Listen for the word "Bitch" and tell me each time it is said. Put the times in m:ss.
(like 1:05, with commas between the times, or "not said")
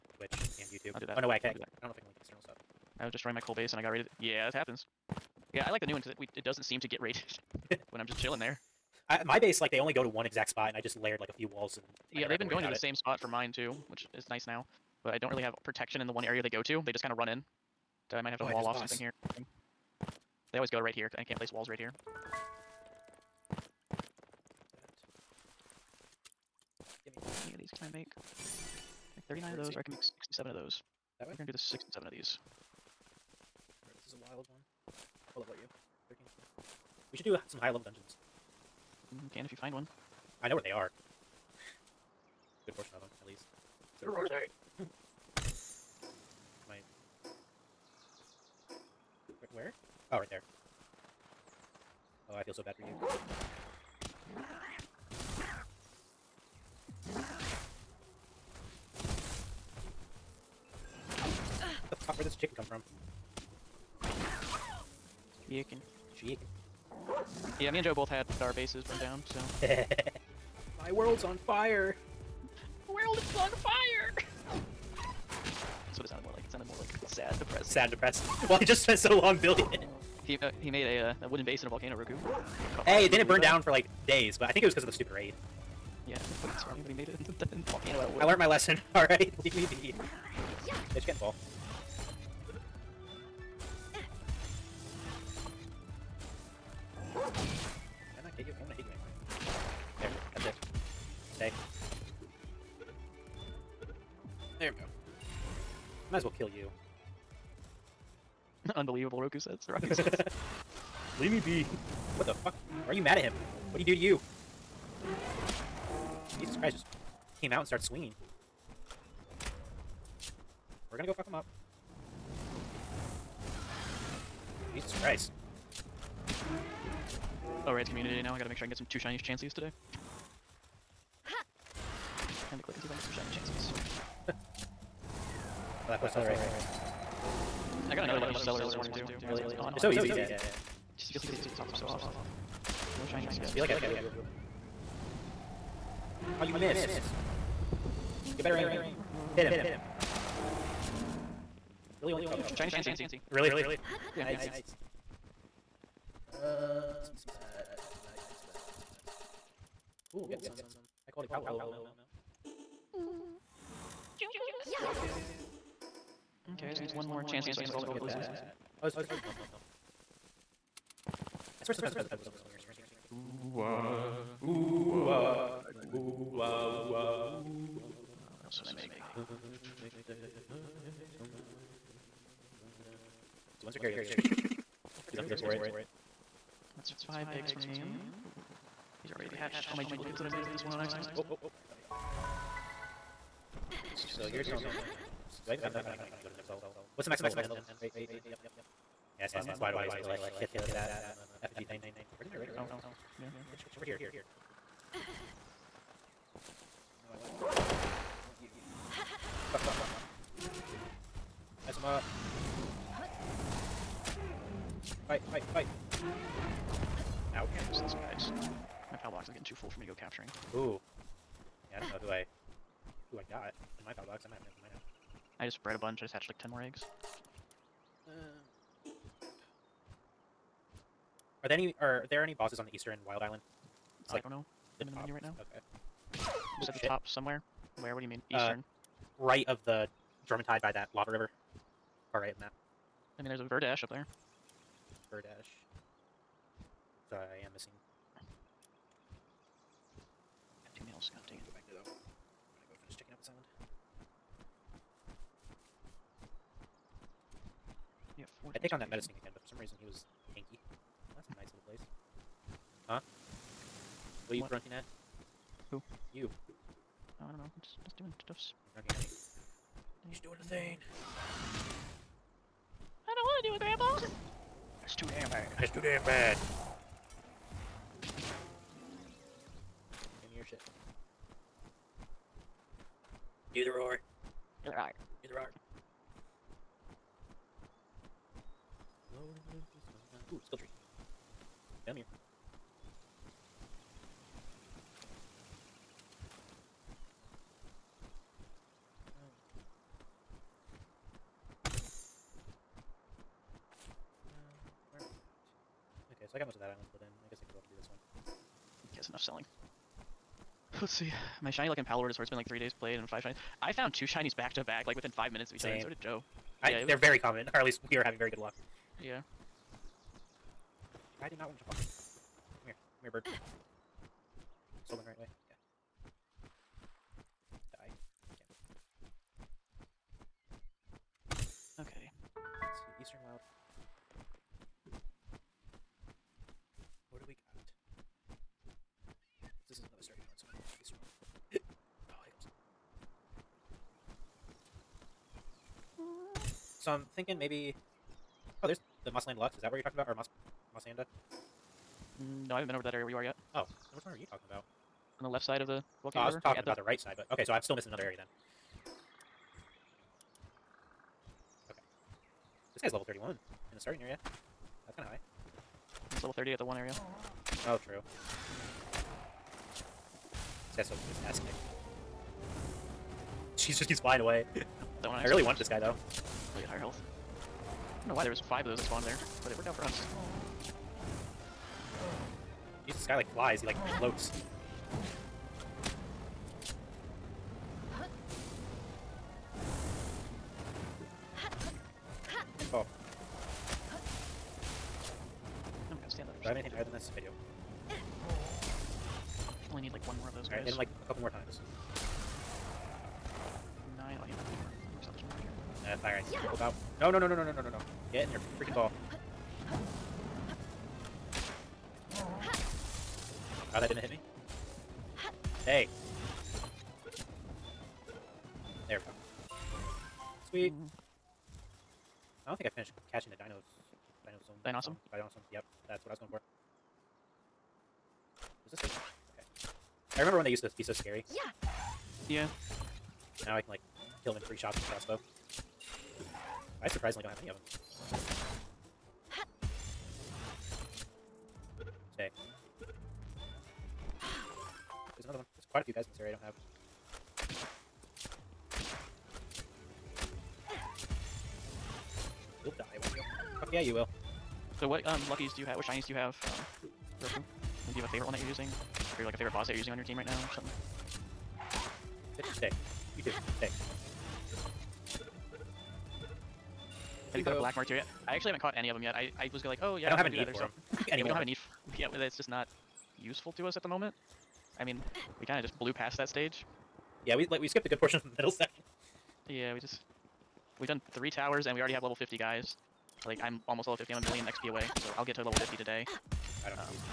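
1:30, 3:23.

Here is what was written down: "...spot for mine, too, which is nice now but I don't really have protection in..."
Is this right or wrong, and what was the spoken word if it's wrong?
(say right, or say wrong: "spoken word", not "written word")
right.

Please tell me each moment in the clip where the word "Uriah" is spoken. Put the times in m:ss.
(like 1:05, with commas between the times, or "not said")
not said.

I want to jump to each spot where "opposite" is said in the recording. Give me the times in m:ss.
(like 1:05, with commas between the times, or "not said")
not said.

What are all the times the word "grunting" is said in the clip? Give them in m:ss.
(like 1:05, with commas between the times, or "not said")
4:24, 4:28.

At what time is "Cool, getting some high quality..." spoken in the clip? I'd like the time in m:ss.
2:40.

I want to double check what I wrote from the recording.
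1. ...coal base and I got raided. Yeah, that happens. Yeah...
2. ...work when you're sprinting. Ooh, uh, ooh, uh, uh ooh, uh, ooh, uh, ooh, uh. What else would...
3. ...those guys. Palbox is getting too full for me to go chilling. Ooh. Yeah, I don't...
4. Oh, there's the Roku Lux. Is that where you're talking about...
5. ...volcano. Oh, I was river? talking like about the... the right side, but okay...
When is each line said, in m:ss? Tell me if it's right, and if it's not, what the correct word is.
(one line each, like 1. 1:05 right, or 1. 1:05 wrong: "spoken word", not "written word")
1. 0:03 right
2. 2:52 right
3. 3:37 wrong: "capturing", not "chilling"
4. 5:48 wrong: "Mossanda", not "Roku"
5. 5:56 right.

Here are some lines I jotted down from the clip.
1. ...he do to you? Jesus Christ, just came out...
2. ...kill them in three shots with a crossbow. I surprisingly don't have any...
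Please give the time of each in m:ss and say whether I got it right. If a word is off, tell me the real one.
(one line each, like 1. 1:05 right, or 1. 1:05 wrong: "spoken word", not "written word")
1. 1:53 right
2. 7:14 right.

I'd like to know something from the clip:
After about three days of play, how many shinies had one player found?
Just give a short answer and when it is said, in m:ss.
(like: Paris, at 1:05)
5, at 5:13.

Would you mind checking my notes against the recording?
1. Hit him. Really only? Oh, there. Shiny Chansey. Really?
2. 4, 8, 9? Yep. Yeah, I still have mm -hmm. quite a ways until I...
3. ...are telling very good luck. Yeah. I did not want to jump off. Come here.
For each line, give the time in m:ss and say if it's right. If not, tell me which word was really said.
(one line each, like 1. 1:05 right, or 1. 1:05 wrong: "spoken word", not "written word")
1. 2:29 right
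2. 3:17 wrong: "8", not "4"
3. 5:17 wrong: "having", not "telling".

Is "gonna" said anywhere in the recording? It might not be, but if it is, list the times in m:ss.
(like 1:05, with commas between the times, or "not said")
0:31, 2:00.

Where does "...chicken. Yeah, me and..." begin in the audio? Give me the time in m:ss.
1:06.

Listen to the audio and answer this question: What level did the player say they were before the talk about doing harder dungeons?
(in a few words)
13.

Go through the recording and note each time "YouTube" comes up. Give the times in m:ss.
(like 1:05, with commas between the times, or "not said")
0:00.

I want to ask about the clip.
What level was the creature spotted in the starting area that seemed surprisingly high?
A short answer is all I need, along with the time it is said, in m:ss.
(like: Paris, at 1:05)
31, at 6:02.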